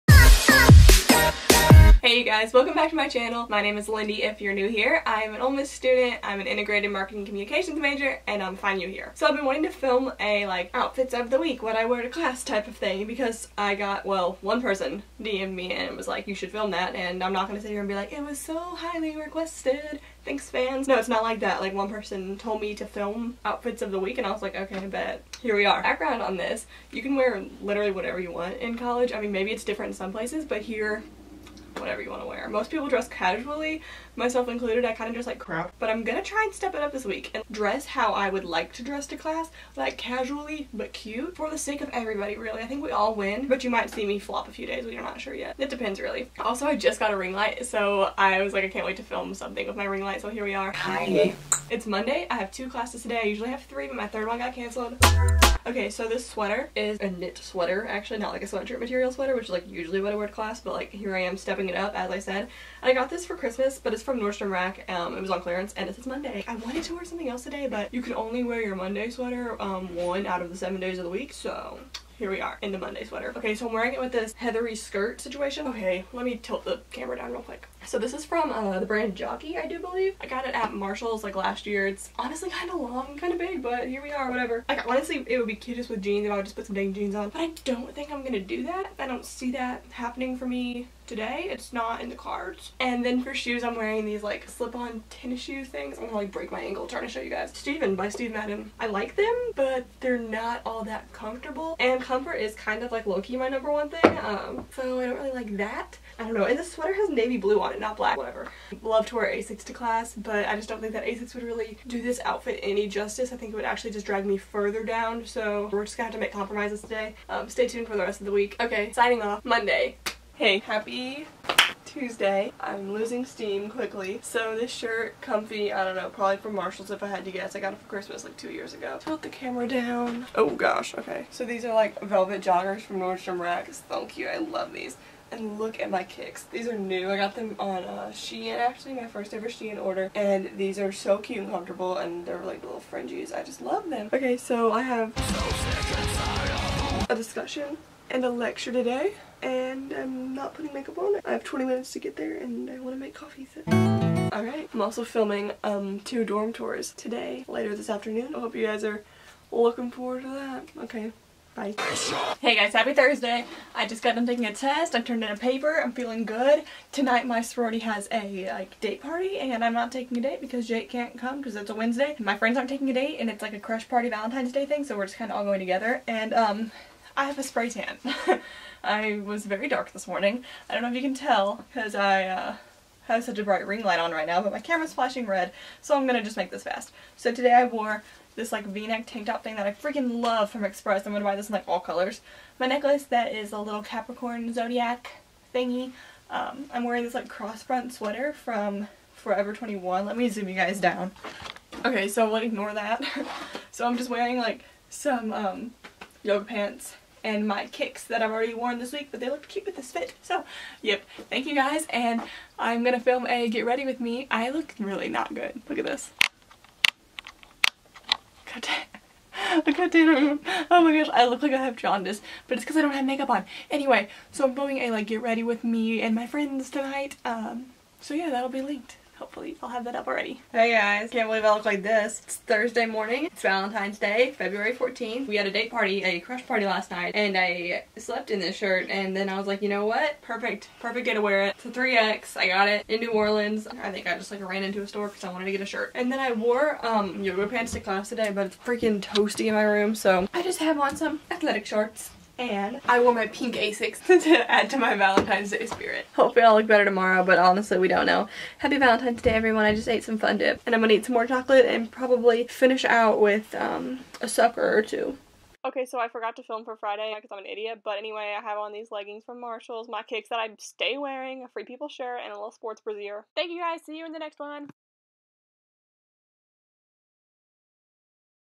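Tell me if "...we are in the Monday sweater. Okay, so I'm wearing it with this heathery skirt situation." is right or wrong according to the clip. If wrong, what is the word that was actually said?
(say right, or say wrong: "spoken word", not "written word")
right.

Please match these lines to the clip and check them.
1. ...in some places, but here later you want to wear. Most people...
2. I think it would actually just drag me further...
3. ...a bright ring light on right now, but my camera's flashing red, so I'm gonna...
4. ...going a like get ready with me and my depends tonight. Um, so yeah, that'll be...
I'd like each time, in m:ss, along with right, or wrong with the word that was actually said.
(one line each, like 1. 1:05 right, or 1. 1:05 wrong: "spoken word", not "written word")
1. 0:29 wrong: "whatever", not "later"
2. 1:53 right
3. 3:03 right
4. 3:44 wrong: "friends", not "depends".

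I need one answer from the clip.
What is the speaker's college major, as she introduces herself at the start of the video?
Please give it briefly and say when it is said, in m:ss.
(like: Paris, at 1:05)
Integrated marketing communications, at 0:06.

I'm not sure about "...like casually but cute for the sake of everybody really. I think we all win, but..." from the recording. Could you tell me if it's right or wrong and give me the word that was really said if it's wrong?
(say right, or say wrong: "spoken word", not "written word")
right.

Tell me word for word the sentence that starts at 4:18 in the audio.
Happy Valentine's Day everyone, I just ate some fun dip.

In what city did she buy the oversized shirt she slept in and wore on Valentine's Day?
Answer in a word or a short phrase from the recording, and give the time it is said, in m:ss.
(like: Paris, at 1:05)
New Orleans, at 4:02.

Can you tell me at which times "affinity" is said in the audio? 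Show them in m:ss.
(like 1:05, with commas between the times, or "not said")
not said.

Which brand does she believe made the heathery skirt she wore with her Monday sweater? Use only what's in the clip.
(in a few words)
Jockey.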